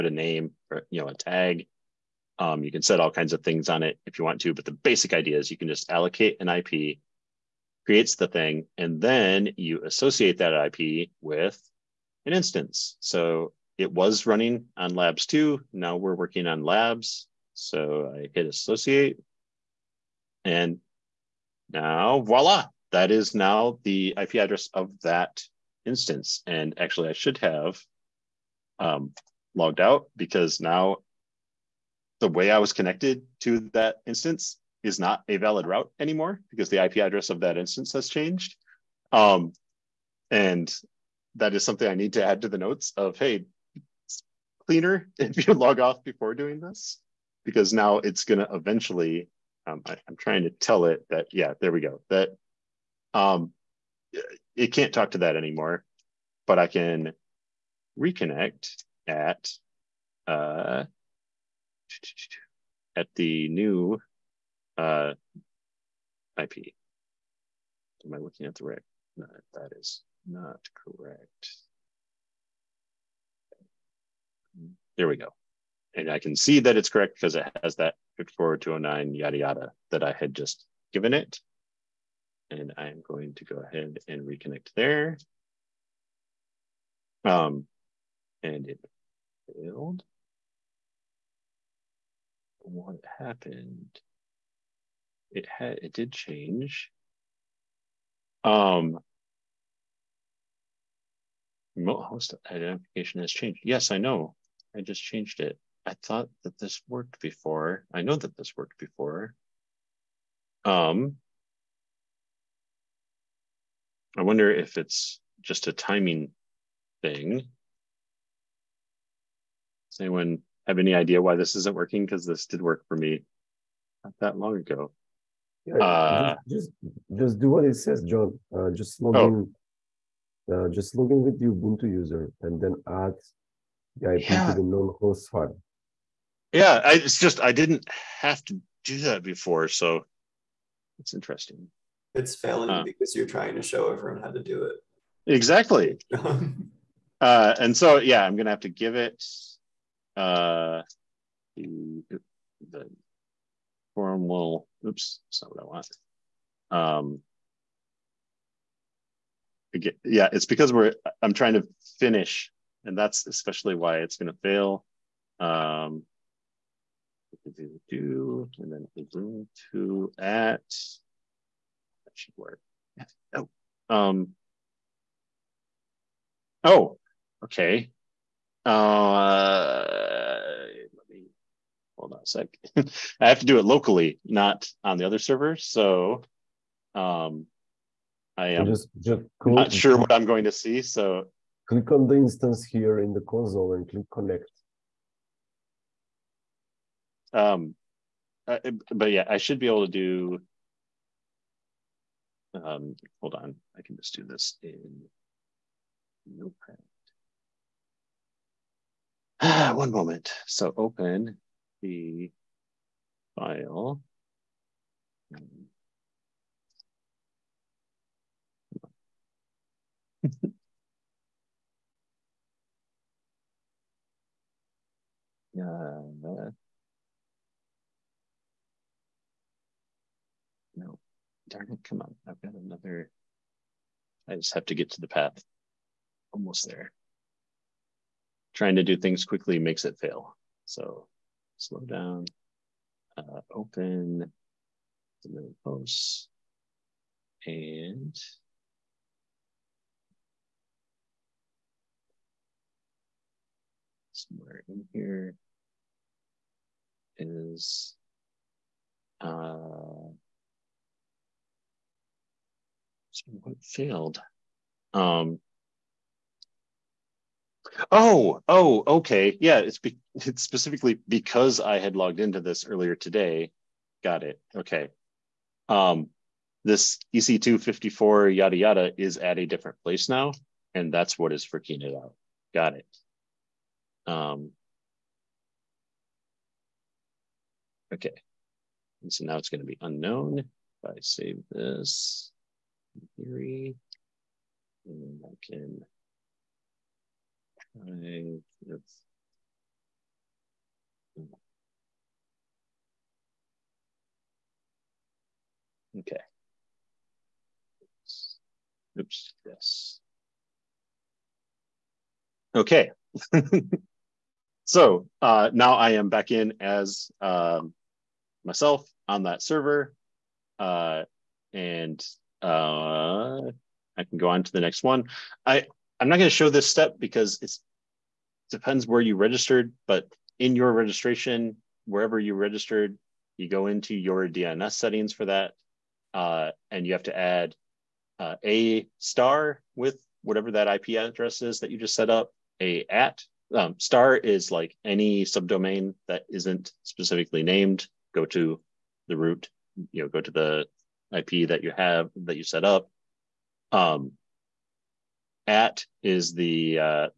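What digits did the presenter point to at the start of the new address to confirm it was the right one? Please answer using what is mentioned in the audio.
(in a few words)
54209.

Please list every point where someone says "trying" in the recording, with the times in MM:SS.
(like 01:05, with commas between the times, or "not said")
00:50, 02:23, 02:41, 03:58.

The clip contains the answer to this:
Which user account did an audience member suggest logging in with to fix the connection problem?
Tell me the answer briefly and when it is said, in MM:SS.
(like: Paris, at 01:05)
Ubuntu, at 02:11.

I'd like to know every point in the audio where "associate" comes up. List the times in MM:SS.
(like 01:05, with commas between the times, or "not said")
00:09, 00:18.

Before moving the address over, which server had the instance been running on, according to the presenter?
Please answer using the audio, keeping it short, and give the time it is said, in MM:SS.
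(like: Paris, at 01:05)
labs two, at 00:14.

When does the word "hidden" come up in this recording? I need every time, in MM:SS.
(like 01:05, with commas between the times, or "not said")
not said.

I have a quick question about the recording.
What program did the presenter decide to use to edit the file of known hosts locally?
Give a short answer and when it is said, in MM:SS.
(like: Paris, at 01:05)
Notepad, at 03:26.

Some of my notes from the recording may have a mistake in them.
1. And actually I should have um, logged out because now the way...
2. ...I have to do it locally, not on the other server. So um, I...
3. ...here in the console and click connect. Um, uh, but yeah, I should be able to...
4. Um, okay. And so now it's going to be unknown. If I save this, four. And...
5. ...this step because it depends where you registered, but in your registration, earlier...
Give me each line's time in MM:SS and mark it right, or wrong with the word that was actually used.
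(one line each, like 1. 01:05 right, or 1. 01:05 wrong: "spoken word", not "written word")
1. 00:26 right
2. 03:03 right
3. 03:12 right
4. 04:44 wrong: "three", not "four"
5. 05:26 wrong: "wherever", not "earlier".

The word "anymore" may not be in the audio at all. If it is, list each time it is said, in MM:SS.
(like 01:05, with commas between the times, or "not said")
00:35, 00:55.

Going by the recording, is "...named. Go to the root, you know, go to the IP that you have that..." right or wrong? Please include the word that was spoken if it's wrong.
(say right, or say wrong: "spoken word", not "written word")
right.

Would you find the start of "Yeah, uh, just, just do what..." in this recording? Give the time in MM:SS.
02:05.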